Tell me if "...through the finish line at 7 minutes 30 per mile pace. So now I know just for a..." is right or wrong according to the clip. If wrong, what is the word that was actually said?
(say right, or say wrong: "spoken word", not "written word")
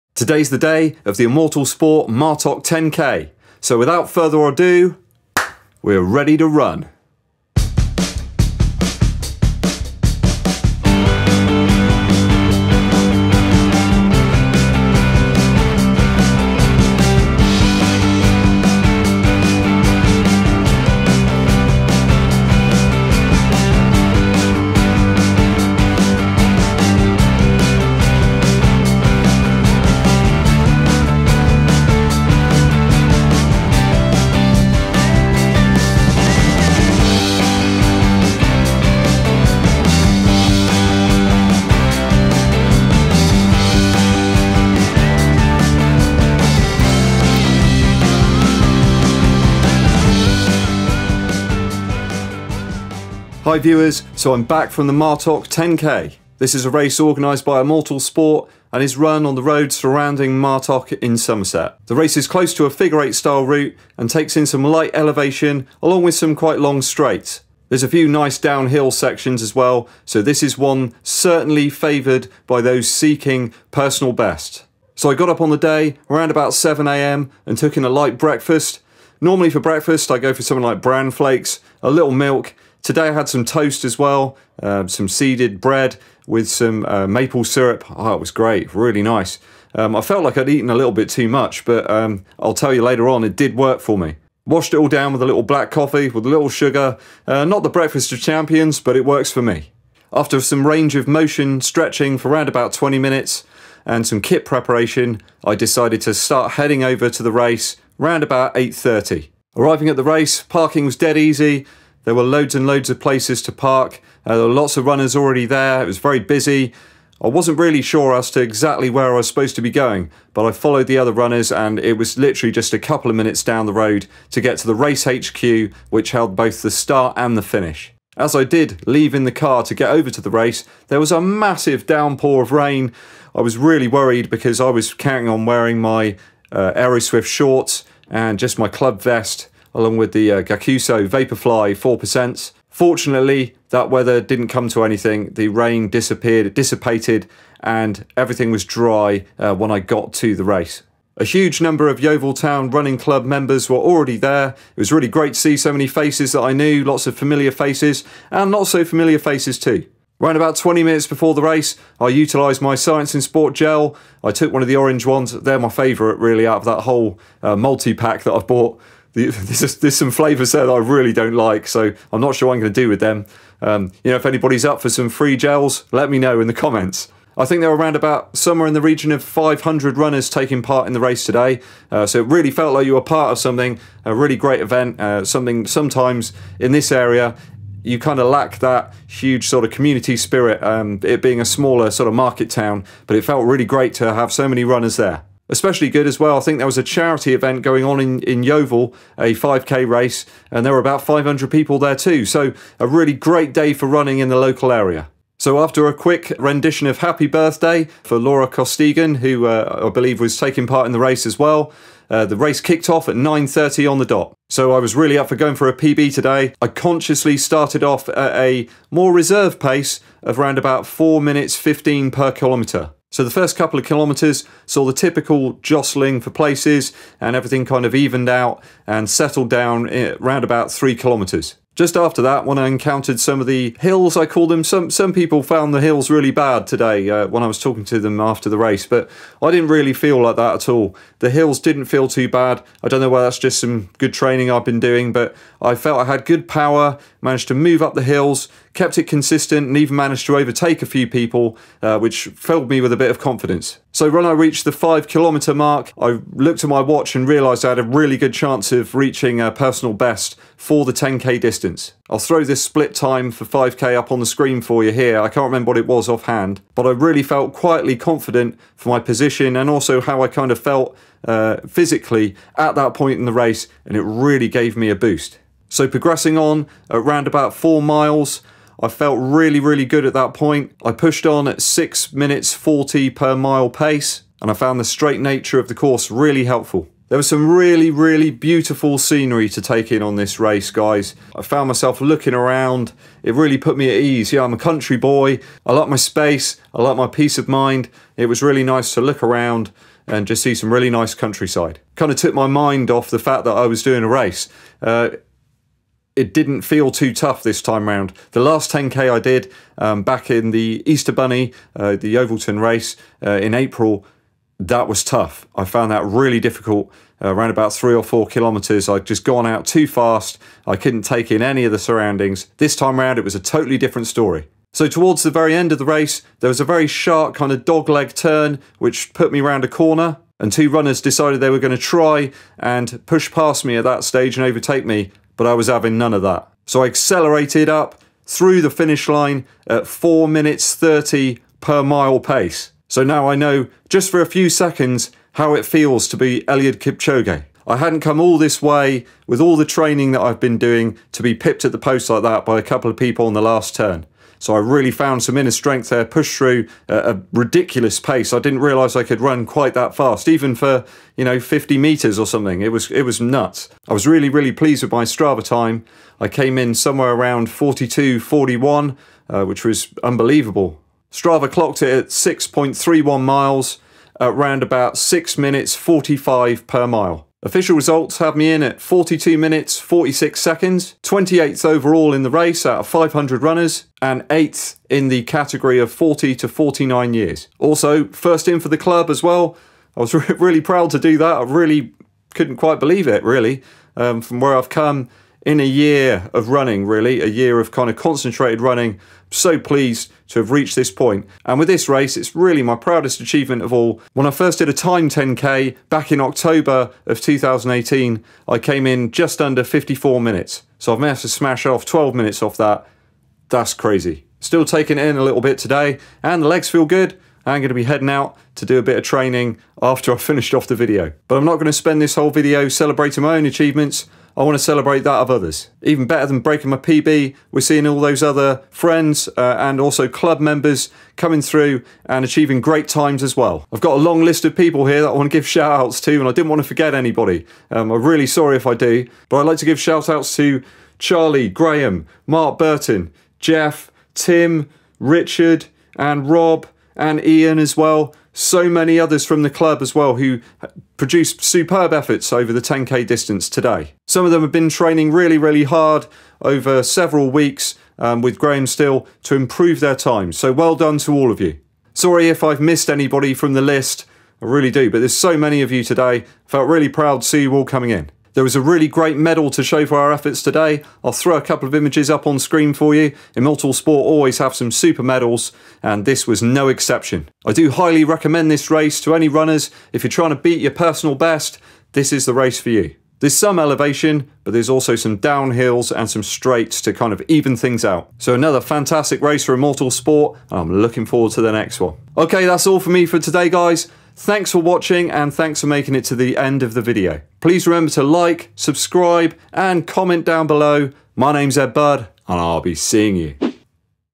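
wrong: "4", not "7".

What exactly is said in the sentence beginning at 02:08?
As I did leave in the car to get over to the race, there was a massive downpour of rain.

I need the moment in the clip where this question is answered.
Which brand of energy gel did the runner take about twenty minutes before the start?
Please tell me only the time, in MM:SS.
02:42.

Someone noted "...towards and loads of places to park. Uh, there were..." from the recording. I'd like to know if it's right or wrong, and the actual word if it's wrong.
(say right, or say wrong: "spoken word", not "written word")
wrong: "loads", not "towards".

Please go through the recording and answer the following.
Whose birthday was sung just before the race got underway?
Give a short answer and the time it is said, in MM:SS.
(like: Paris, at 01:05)
Laura Costigan, at 03:28.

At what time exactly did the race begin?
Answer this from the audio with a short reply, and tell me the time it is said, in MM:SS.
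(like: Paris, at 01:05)
9.30, at 03:33.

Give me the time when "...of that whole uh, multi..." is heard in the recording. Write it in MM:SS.
02:46.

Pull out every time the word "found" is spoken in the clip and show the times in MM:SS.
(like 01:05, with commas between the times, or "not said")
03:55, 04:44, 04:51, 05:15, 05:54.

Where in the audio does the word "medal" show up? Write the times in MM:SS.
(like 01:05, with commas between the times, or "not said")
07:49, 07:55.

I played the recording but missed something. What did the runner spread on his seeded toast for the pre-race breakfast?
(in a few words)
Maple syrup.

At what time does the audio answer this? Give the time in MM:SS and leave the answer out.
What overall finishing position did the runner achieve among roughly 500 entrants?
06:21.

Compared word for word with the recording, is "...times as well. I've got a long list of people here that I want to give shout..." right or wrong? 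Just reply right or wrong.
right.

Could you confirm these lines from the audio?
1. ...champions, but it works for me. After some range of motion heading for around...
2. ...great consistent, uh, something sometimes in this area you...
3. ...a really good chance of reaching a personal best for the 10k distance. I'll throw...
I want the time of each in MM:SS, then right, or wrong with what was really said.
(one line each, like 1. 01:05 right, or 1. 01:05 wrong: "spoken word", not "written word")
1. 01:38 wrong: "stretching", not "heading"
2. 03:04 wrong: "event", not "consistent"
3. 04:17 right.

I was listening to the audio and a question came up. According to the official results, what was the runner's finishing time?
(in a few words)
42 minutes 46 seconds.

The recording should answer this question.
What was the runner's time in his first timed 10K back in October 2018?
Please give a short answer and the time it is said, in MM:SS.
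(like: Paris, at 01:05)
Just under 54 minutes, at 06:49.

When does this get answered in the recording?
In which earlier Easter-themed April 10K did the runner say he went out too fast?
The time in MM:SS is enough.
05:11.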